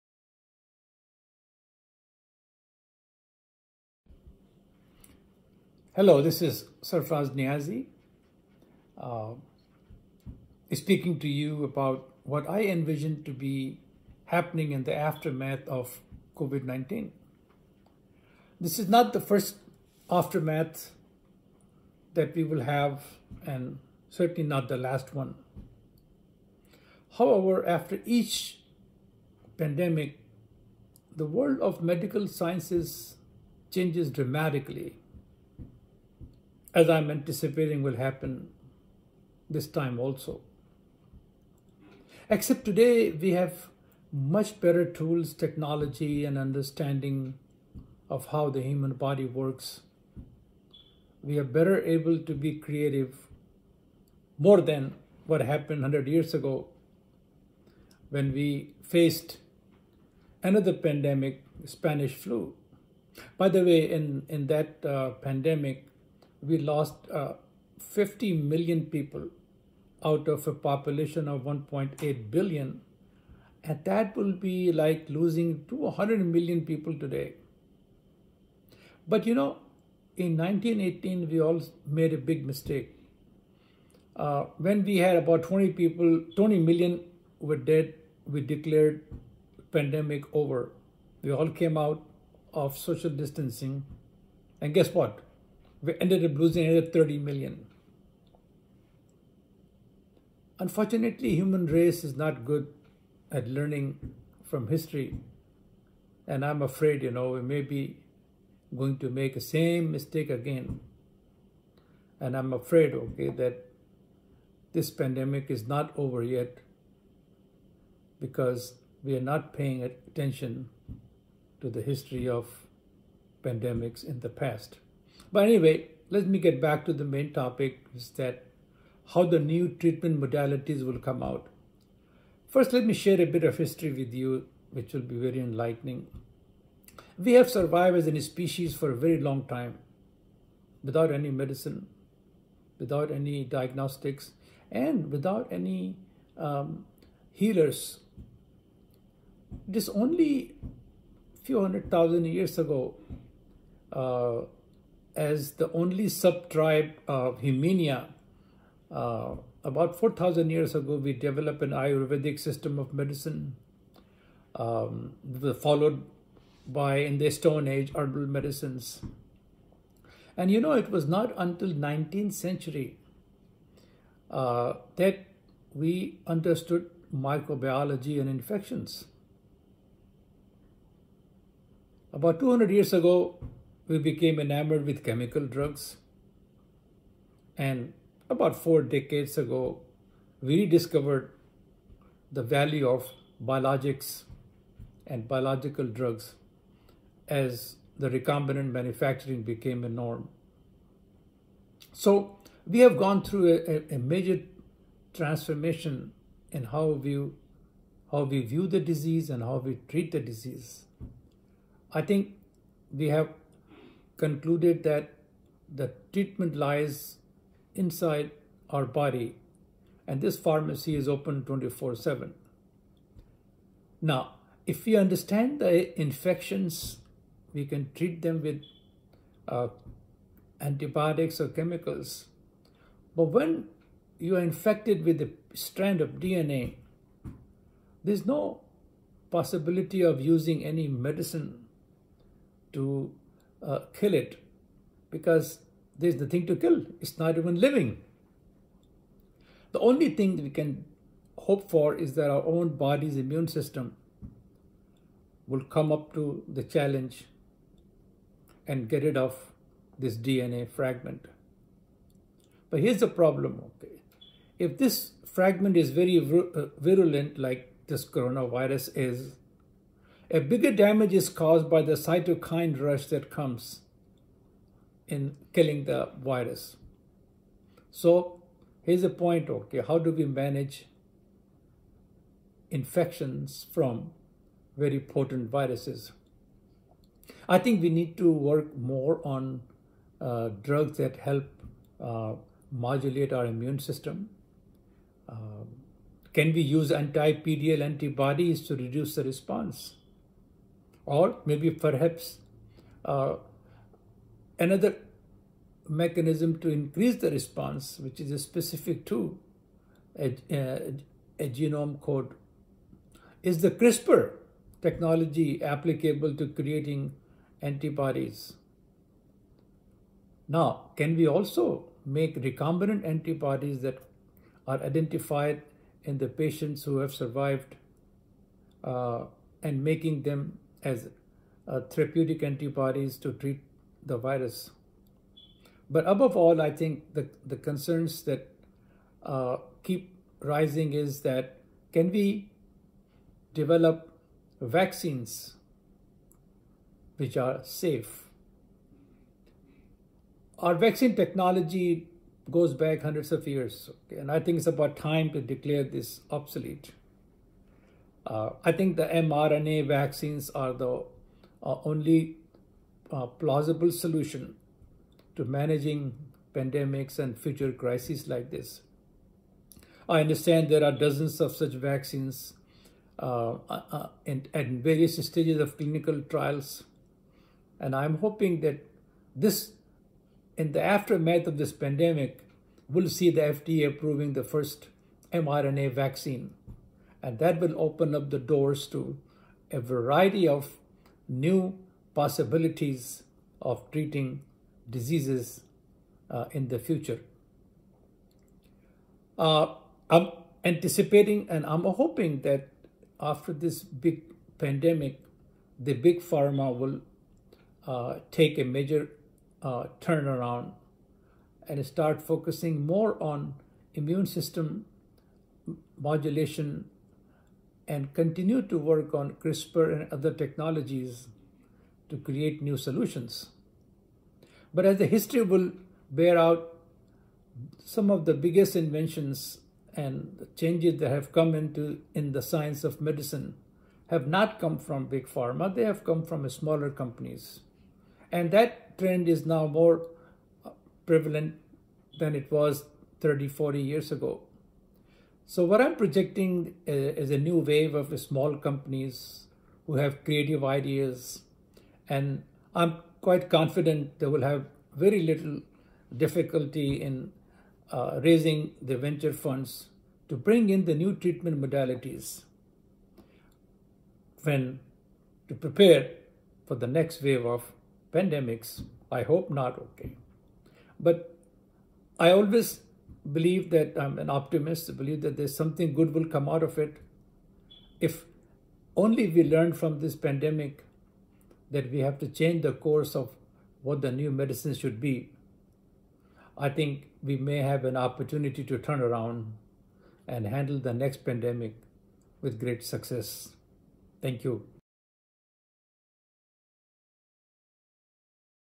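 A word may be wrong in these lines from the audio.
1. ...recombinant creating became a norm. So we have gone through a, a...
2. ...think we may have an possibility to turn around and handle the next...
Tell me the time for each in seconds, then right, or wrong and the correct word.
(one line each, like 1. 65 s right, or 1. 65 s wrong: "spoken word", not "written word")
1. 198 s wrong: "manufacturing", not "creating"
2. 486 s wrong: "opportunity", not "possibility".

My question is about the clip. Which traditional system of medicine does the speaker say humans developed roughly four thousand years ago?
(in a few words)
Ayurvedic.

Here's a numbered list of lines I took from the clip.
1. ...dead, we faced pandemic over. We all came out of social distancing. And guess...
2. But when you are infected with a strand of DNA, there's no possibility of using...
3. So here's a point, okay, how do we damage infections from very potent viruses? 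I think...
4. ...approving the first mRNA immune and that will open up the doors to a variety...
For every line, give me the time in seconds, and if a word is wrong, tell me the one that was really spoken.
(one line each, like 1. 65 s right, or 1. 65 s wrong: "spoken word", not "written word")
1. 87 s wrong: "declared", not "faced"
2. 233 s right
3. 277 s wrong: "manage", not "damage"
4. 383 s wrong: "vaccine", not "immune".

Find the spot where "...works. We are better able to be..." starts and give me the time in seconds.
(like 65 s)
49 s.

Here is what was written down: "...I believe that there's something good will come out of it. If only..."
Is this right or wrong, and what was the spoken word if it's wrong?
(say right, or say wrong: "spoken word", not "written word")
right.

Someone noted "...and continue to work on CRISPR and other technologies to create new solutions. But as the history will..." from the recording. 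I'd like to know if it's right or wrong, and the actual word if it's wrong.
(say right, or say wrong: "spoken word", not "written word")
right.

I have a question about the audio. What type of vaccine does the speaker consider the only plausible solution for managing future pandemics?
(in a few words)
mRNA vaccines.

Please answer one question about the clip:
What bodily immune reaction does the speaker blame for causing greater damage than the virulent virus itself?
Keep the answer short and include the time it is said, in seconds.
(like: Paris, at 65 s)
cytokine rush, at 272 s.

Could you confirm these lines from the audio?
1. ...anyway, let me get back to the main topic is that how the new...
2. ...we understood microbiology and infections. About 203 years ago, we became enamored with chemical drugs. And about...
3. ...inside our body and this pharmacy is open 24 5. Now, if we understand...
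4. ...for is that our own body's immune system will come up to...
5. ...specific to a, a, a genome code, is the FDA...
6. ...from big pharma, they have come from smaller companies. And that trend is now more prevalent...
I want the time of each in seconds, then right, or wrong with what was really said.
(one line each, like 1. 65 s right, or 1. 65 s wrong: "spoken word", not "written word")
1. 125 s right
2. 175 s wrong: "200", not "203"
3. 217 s wrong: "7", not "5"
4. 251 s right
5. 308 s wrong: "CRISPR", not "FDA"
6. 434 s right.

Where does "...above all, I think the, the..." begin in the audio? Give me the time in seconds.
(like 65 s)
336 s.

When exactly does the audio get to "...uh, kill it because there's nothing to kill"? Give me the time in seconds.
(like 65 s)
243 s.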